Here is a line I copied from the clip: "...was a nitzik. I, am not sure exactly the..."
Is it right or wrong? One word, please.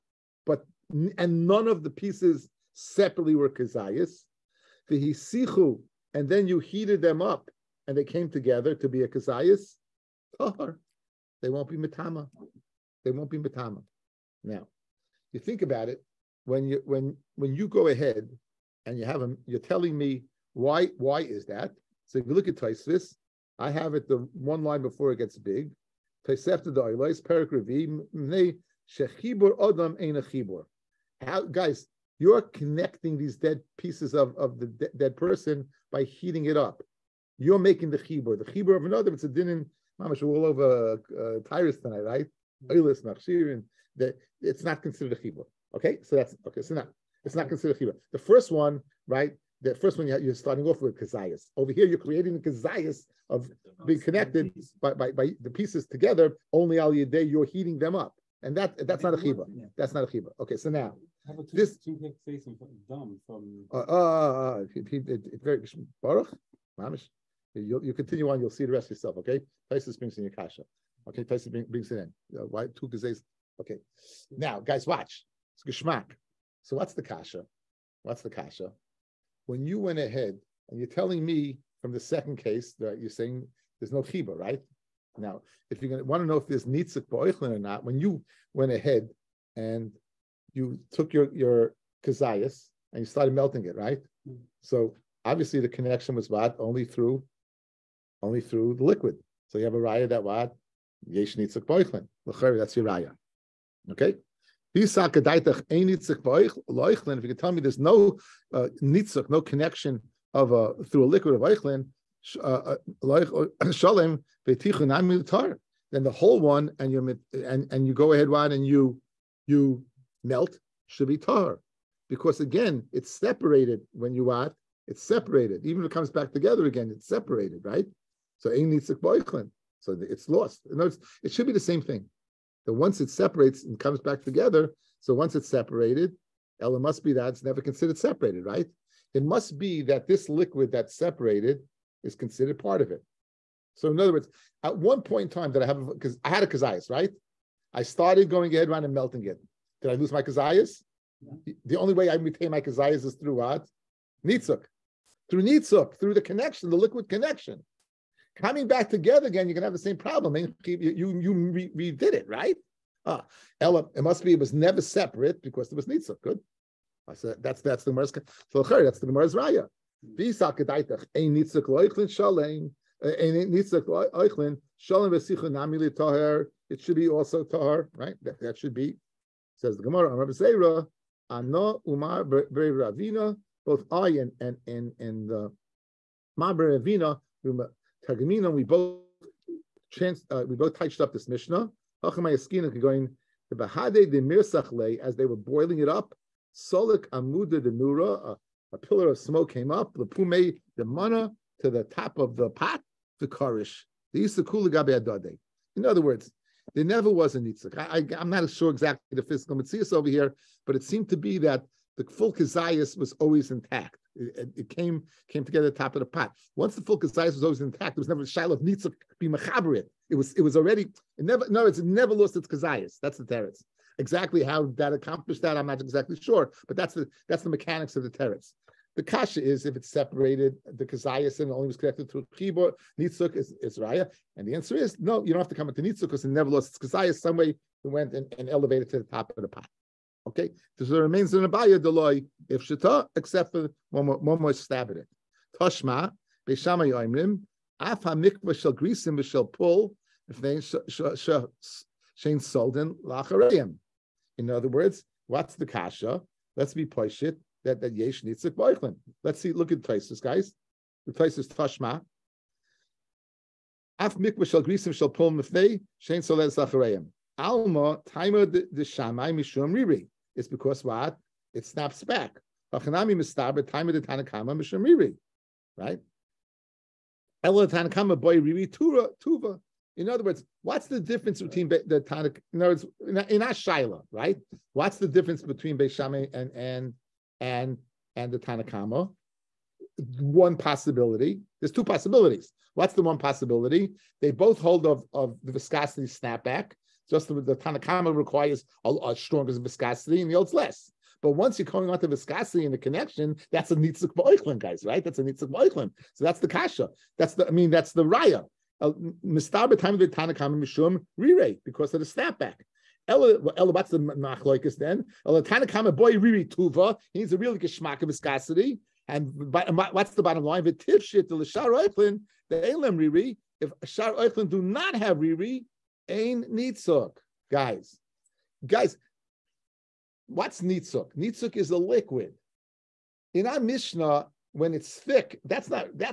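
right.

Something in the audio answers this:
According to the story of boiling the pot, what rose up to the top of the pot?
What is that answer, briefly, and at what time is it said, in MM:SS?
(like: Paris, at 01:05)
A pillar of smoke, at 03:16.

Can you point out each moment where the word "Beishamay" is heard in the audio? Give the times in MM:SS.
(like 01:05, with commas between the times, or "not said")
04:45.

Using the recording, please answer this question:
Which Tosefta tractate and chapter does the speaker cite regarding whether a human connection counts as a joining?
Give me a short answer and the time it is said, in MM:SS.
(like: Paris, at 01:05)
Oholos, Perek 4, at 00:26.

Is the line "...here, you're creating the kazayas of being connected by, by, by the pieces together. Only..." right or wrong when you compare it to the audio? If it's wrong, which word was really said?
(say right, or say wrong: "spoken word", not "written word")
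right.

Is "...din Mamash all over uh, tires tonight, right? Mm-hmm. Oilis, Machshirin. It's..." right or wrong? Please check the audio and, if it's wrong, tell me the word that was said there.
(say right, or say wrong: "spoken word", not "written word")
right.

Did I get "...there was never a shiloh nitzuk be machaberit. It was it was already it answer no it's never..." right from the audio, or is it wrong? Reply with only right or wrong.
wrong.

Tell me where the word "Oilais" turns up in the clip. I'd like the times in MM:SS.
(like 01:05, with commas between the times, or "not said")
00:26.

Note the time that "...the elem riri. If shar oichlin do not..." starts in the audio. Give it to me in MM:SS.
05:22.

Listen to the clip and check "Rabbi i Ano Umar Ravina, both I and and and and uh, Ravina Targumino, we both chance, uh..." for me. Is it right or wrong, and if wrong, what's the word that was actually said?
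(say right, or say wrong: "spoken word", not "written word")
right.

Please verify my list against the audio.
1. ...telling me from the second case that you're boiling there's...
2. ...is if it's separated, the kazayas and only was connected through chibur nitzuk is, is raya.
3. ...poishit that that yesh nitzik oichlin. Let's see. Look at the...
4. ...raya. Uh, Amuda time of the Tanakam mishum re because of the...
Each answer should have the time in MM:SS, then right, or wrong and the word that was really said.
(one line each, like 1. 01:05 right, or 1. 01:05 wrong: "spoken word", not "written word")
1. 01:20 wrong: "saying", not "boiling"
2. 03:49 right
3. 04:16 wrong: "boichlin", not "oichlin"
4. 05:08 wrong: "Mistaber", not "Amuda".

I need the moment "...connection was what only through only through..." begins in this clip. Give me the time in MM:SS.
01:35.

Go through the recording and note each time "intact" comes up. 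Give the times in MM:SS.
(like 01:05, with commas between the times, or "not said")
03:33, 03:37.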